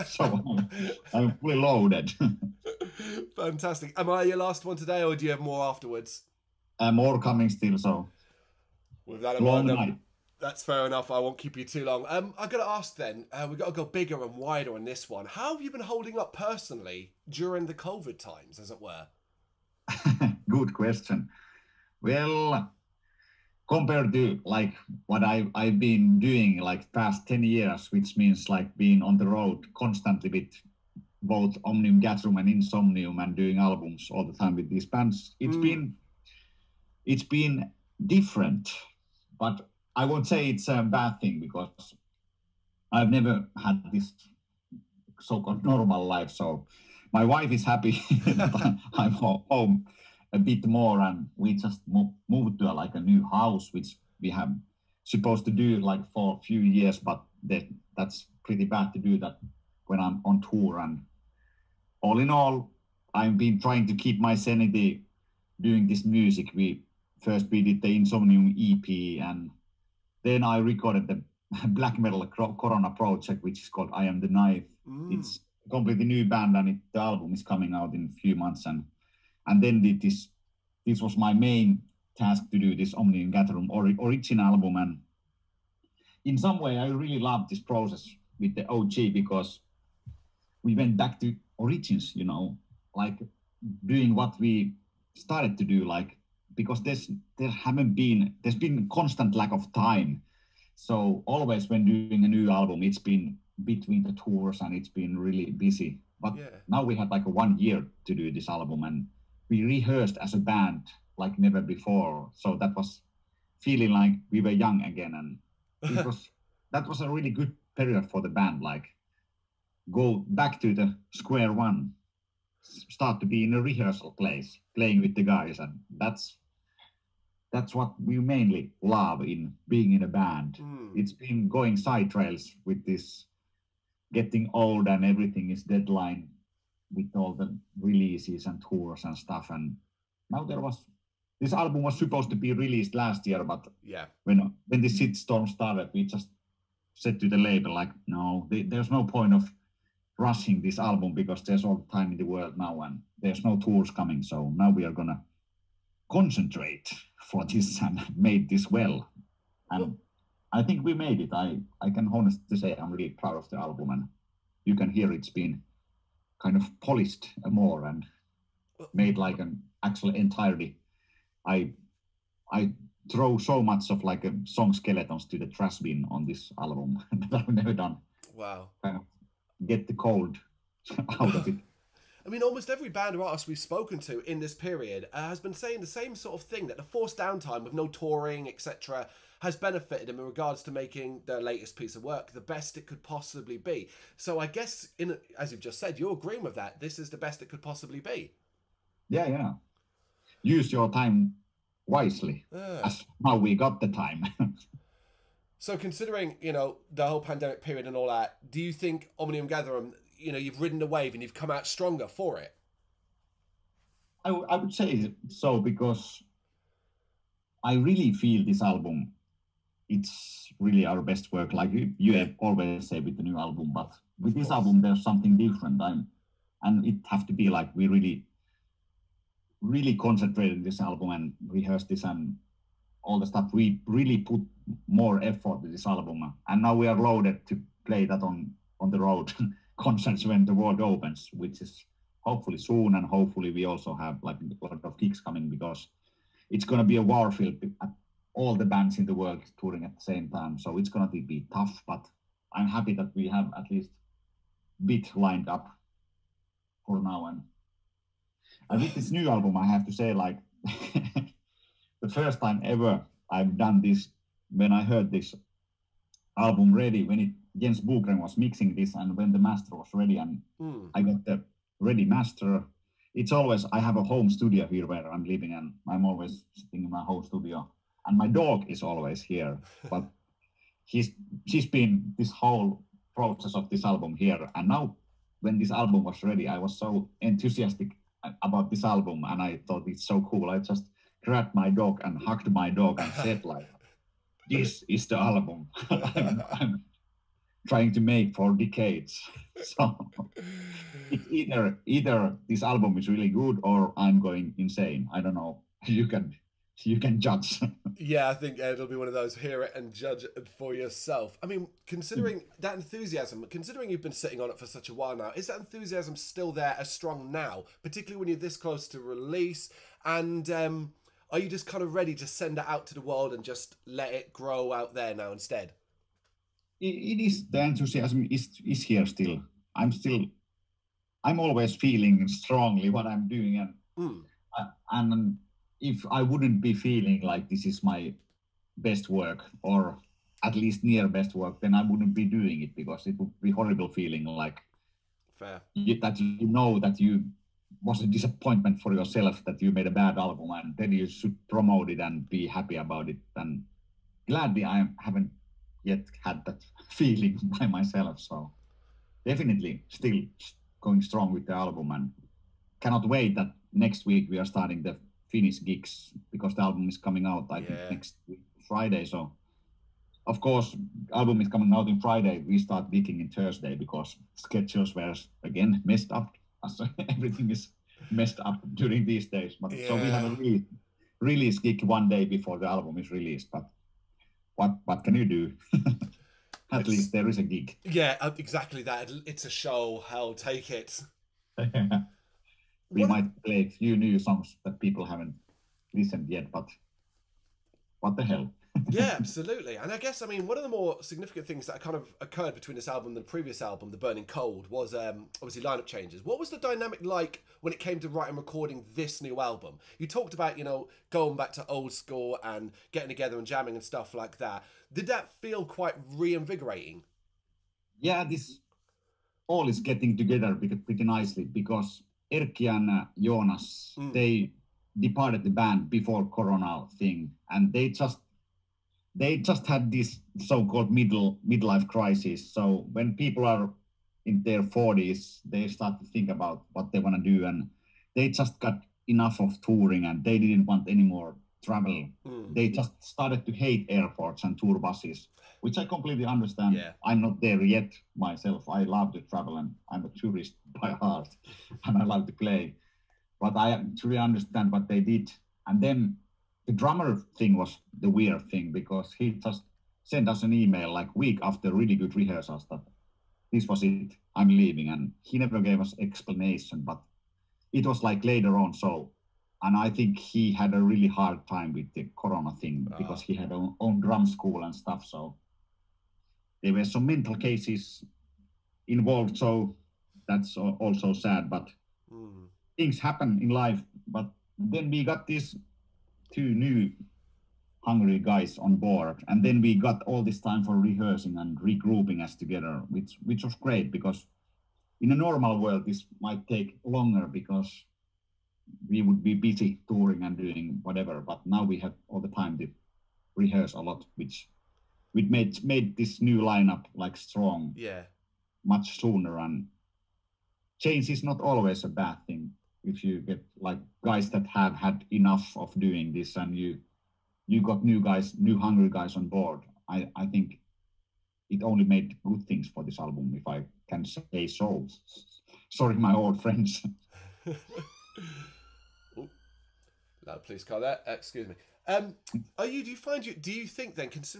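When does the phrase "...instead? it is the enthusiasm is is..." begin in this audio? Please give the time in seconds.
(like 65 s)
325 s.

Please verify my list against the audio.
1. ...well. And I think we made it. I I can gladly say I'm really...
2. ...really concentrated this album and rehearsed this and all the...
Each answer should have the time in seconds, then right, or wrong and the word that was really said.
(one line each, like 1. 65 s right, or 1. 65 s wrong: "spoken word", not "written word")
1. 158 s wrong: "honestly", not "gladly"
2. 229 s right.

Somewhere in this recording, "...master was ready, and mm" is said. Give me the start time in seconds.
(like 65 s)
269 s.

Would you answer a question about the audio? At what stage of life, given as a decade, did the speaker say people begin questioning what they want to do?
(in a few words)
40s.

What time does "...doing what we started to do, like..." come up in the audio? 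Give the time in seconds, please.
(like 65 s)
93 s.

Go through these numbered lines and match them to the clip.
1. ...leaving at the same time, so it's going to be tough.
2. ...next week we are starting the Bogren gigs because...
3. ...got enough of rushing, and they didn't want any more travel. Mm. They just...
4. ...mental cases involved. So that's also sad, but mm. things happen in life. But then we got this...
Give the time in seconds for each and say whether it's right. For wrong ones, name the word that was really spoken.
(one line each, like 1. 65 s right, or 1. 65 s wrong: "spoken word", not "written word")
1. 249 s wrong: "touring", not "leaving"
2. 363 s wrong: "Finnish", not "Bogren"
3. 438 s wrong: "touring", not "rushing"
4. 477 s right.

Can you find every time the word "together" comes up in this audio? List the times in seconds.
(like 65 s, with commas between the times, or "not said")
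413 s, 420 s, 492 s.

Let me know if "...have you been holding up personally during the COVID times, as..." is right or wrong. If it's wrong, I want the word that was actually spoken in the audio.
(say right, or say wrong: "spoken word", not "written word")
right.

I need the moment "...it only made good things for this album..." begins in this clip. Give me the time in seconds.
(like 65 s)
521 s.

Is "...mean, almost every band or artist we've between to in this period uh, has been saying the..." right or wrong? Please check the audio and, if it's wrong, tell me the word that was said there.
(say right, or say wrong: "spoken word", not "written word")
wrong: "spoken", not "between".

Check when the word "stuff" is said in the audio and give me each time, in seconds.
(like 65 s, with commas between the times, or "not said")
139 s, 233 s, 413 s, 474 s.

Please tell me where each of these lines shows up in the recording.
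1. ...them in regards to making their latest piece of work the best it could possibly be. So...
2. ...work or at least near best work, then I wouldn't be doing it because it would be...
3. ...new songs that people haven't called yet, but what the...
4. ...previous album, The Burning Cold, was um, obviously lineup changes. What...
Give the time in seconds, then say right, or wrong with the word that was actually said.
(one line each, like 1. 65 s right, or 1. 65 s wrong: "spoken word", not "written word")
1. 190 s right
2. 339 s right
3. 393 s wrong: "listened", not "called"
4. 403 s right.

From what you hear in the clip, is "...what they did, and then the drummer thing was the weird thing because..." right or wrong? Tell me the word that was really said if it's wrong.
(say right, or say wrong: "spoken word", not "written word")
right.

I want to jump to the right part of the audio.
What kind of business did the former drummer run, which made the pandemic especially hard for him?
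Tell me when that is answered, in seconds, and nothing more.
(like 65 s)
474 s.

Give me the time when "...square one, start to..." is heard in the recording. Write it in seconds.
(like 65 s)
121 s.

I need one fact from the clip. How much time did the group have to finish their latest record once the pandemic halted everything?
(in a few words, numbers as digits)
one year.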